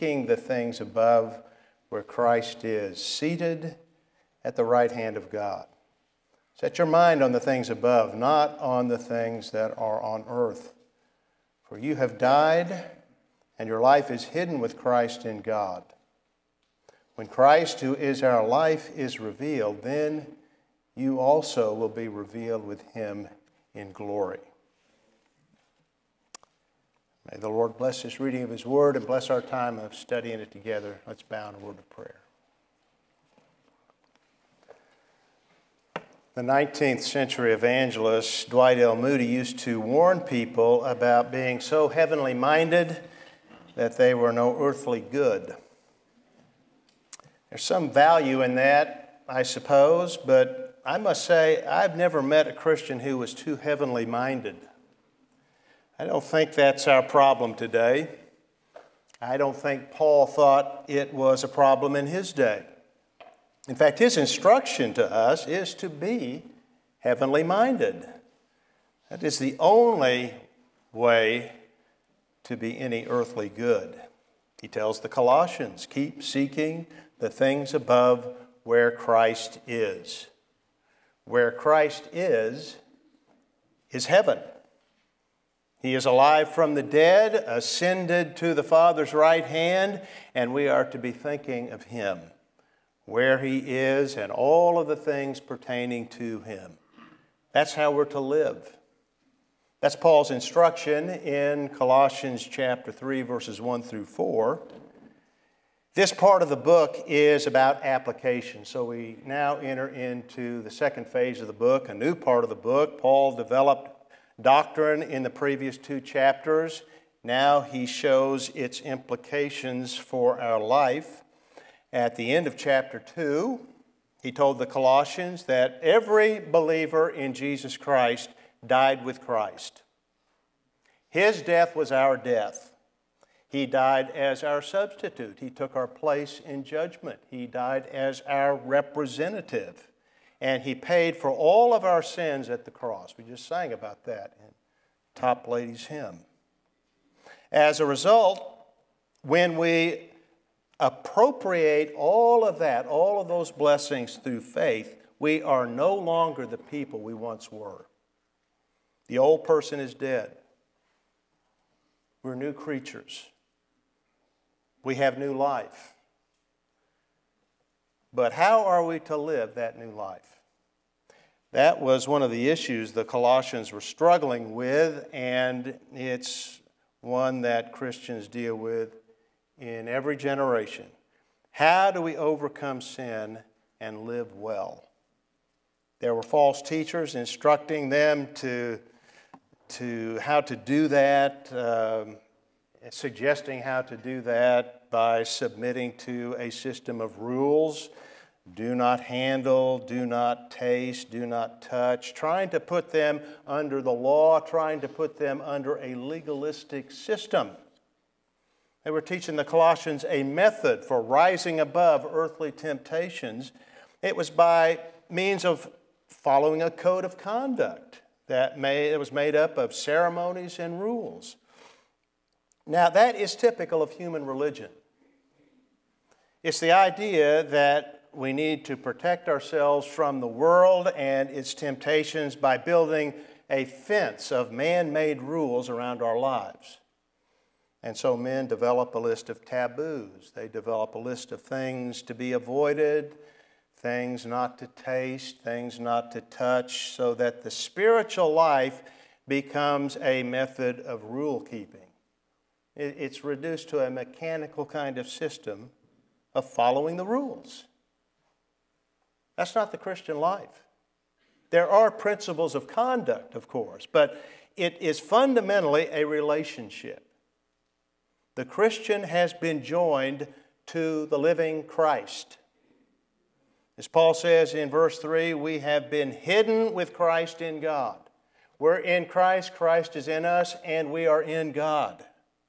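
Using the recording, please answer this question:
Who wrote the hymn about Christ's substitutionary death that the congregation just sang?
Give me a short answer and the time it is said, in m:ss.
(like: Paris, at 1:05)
Toplady, at 2:25.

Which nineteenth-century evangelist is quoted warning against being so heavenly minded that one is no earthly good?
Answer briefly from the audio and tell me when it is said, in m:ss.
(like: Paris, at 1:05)
Dwight L. Moody, at 0:38.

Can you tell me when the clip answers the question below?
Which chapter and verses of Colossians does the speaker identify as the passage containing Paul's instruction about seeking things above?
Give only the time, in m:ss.
1:42.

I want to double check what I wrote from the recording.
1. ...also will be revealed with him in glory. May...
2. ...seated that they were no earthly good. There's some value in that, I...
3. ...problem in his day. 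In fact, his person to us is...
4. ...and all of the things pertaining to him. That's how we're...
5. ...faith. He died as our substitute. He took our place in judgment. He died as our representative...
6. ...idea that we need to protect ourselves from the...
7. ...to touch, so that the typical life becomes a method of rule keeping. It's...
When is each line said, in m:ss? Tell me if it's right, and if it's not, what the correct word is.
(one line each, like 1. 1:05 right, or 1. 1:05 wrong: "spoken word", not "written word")
1. 0:21 right
2. 0:42 wrong: "minded", not "seated"
3. 1:01 wrong: "instruction", not "person"
4. 1:34 right
5. 2:12 wrong: "death", not "faith"
6. 3:46 right
7. 4:06 wrong: "spiritual", not "typical".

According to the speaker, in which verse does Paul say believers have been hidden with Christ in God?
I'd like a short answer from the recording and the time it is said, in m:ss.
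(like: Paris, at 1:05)
Verse 3, at 4:34.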